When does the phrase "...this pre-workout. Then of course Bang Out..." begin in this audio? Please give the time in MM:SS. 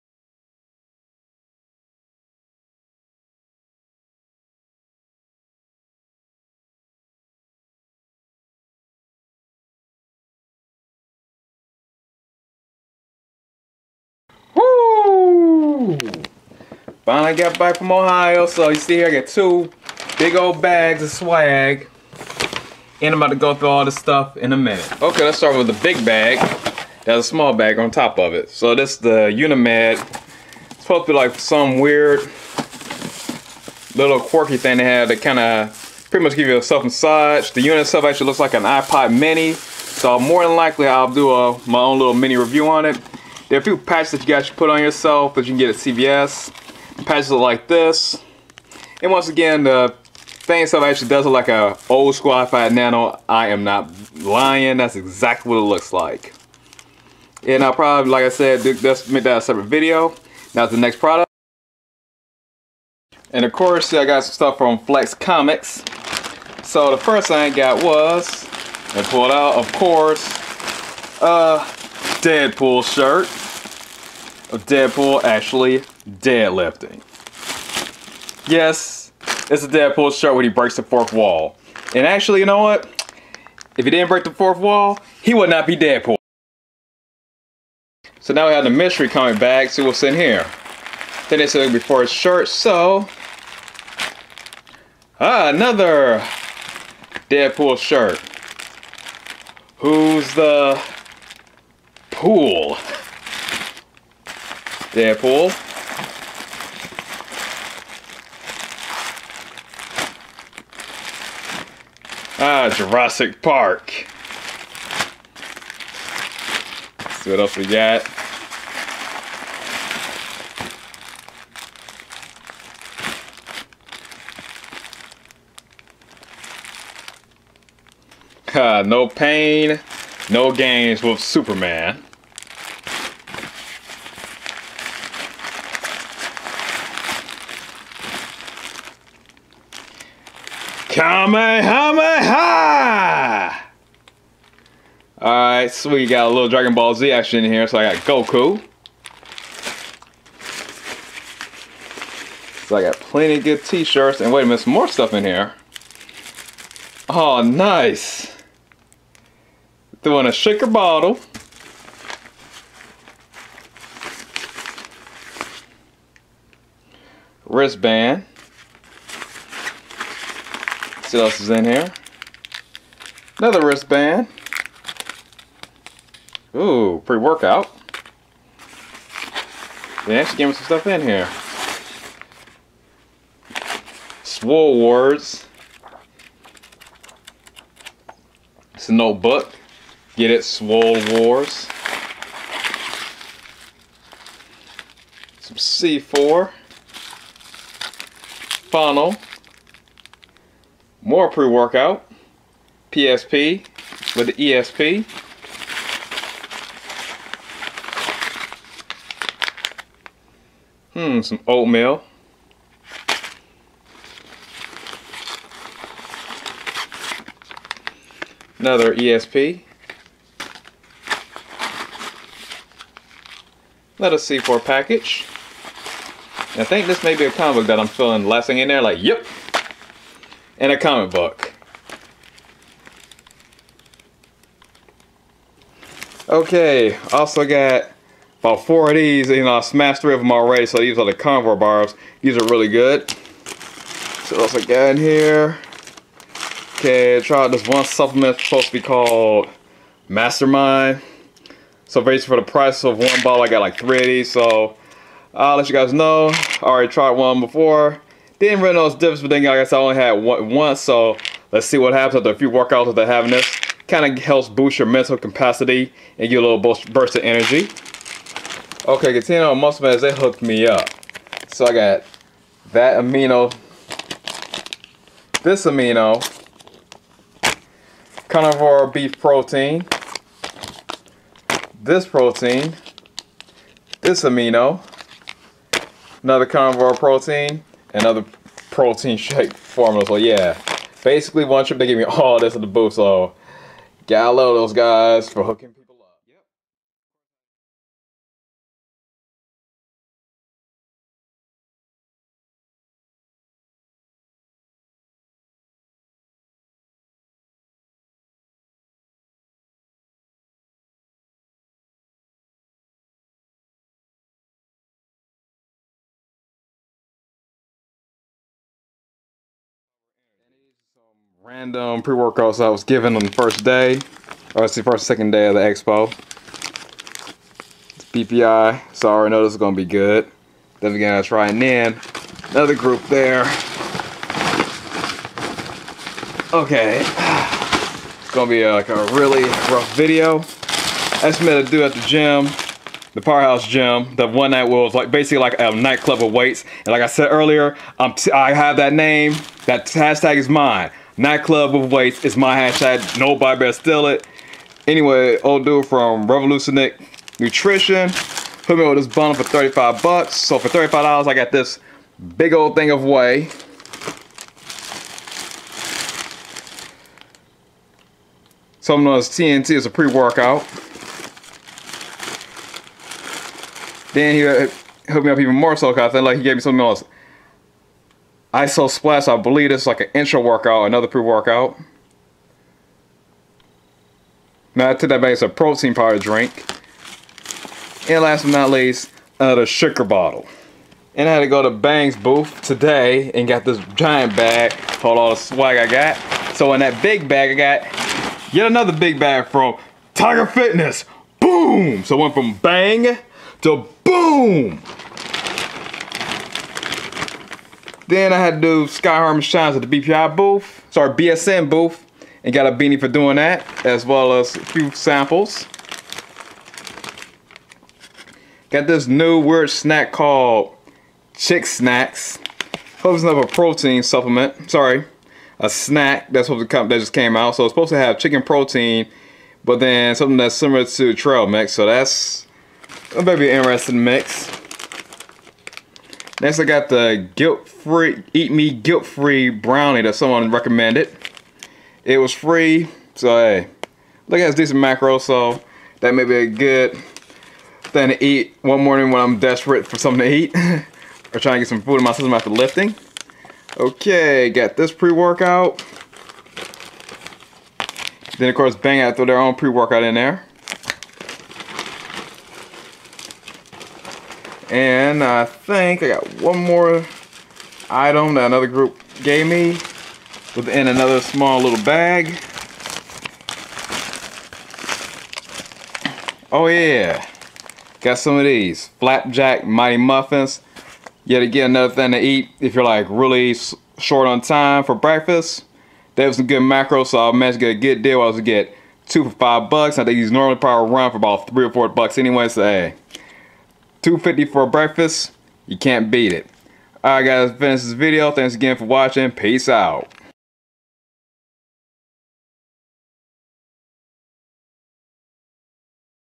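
07:34.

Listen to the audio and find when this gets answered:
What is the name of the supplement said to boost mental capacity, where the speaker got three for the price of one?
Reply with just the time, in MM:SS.
04:10.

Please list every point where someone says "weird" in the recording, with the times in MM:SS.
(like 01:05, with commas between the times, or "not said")
00:31, 06:59.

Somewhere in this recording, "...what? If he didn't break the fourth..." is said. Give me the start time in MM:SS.
01:22.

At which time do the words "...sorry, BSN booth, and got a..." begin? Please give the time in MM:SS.
06:50.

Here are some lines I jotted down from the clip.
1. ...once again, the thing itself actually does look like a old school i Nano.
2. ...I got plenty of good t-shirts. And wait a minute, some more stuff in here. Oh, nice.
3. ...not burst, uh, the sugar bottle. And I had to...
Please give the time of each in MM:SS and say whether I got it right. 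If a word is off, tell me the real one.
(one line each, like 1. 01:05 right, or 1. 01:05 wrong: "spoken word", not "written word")
1. 00:49 right
2. 02:32 right
3. 06:28 wrong: "least", not "burst".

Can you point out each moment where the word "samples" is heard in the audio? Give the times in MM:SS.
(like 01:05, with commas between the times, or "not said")
06:54.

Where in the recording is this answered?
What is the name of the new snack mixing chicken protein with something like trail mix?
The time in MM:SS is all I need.
07:01.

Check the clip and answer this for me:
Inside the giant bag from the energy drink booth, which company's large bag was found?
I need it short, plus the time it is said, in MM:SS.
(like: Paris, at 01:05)
Tiger Fitness, at 06:40.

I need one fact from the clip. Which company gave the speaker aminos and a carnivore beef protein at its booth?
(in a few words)
Muscle Meds.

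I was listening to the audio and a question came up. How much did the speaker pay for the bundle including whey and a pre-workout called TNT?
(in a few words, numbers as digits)
$35.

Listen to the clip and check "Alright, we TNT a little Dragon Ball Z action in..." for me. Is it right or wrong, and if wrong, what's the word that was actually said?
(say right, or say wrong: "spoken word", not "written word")
wrong: "Got", not "TNT".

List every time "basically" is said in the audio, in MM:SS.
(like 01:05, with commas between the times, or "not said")
04:12, 04:51, 05:45.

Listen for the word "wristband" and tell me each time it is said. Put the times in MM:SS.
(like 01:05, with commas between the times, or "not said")
02:47, 02:53.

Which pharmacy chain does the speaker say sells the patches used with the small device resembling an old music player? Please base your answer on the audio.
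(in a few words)
CVS.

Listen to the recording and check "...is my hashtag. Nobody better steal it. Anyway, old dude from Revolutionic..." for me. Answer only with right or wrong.
right.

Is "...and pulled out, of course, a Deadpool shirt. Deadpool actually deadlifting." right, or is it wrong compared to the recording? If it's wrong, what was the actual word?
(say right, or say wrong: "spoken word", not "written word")
right.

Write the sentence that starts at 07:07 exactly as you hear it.
So it's supposed to have chicken protein, but then something that's similar to trail mix.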